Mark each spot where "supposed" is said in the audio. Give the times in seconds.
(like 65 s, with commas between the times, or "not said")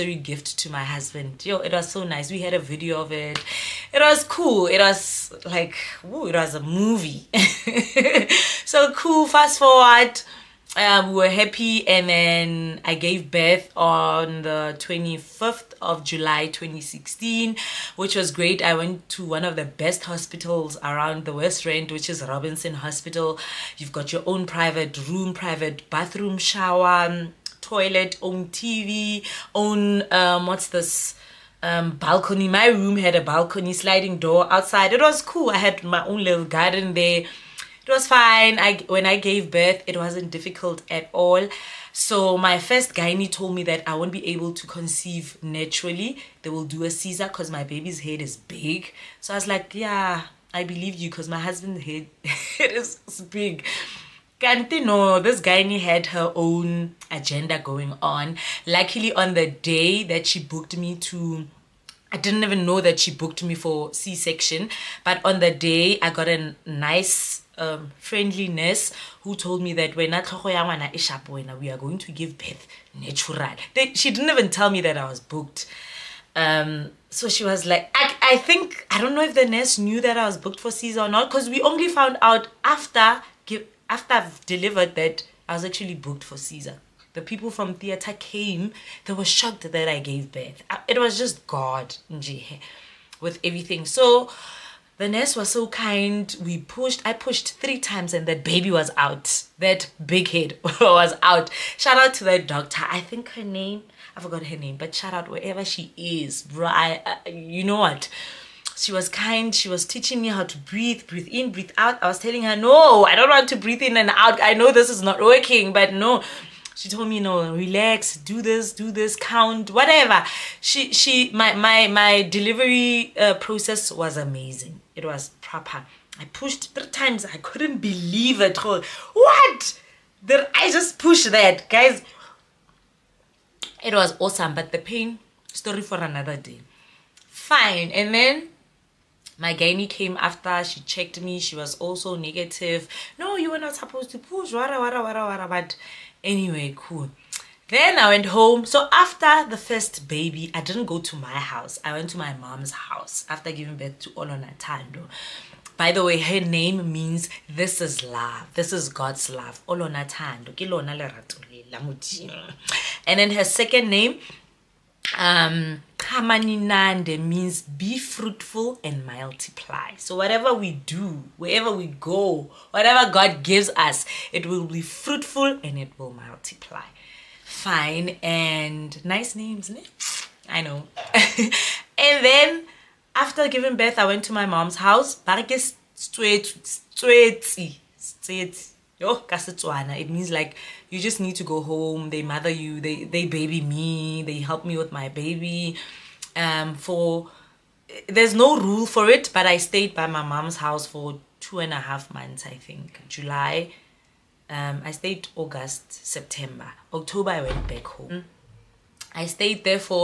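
143 s.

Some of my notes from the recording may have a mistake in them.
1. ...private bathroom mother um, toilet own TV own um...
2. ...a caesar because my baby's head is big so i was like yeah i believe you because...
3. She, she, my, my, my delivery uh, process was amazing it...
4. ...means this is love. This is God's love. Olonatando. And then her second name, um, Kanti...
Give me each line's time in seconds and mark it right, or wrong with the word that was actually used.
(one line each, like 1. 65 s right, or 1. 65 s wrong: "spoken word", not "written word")
1. 25 s wrong: "shower", not "mother"
2. 46 s right
3. 120 s right
4. 156 s wrong: "Kamaninande", not "Kanti".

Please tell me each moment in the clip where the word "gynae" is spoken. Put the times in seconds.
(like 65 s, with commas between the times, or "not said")
42 s, 55 s, 139 s.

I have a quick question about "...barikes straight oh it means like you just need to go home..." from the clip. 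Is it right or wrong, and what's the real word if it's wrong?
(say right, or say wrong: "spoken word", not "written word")
right.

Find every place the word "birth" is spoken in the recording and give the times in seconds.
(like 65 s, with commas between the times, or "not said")
13 s, 39 s, 72 s, 90 s, 153 s, 183 s.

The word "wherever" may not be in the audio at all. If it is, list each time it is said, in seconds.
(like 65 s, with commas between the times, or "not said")
105 s, 171 s.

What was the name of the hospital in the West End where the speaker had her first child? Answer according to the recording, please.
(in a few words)
Robinson Hospital.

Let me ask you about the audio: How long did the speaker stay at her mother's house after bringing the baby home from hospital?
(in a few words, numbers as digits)
2 and a half months.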